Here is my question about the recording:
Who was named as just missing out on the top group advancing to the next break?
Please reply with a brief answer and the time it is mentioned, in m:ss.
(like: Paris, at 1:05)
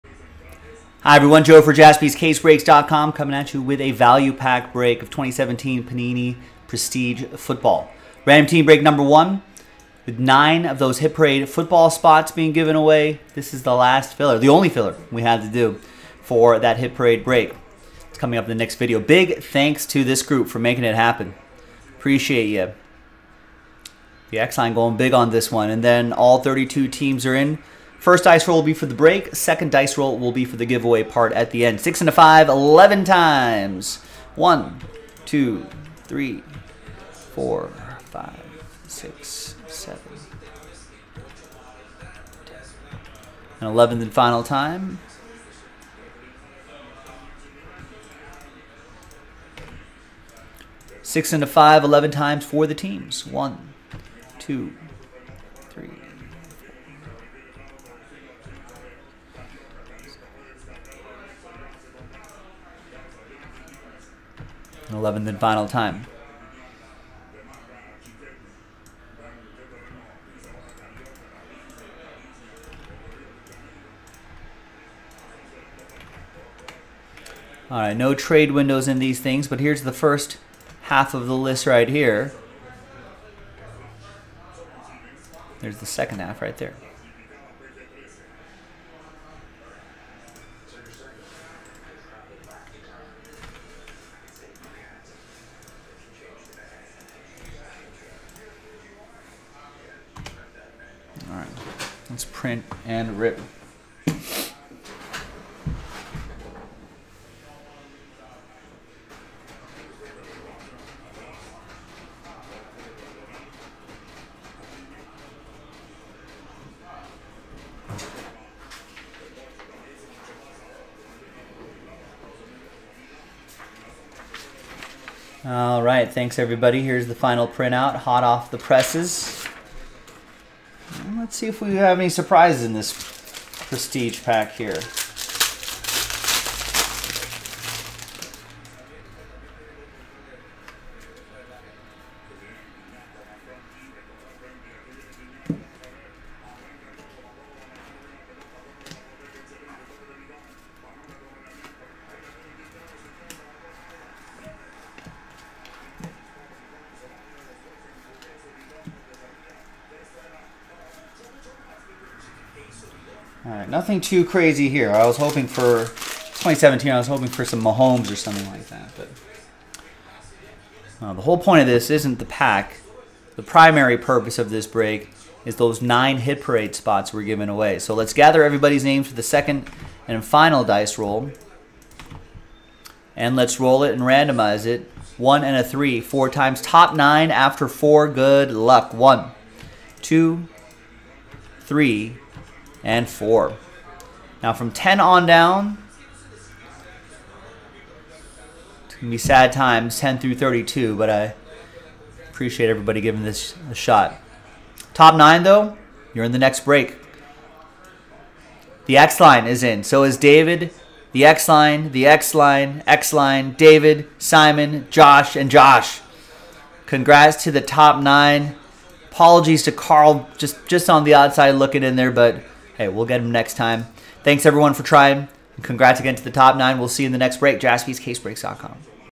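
Carl, at 3:39.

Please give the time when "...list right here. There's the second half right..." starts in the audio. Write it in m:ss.
1:21.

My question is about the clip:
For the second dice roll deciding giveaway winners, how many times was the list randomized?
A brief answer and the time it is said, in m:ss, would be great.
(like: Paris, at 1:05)
4, at 3:05.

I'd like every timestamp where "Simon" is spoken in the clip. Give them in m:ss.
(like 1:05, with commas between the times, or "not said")
3:34.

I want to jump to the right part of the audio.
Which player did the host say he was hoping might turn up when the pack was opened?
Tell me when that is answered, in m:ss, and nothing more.
2:47.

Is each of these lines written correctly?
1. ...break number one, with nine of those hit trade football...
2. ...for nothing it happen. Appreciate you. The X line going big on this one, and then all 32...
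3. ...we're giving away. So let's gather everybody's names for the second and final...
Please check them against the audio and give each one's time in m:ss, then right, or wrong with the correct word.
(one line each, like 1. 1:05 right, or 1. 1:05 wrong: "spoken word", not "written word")
1. 0:08 wrong: "parade", not "trade"
2. 0:20 wrong: "making", not "nothing"
3. 2:57 right.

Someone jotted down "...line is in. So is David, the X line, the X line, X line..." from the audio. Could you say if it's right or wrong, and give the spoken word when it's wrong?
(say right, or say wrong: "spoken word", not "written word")
right.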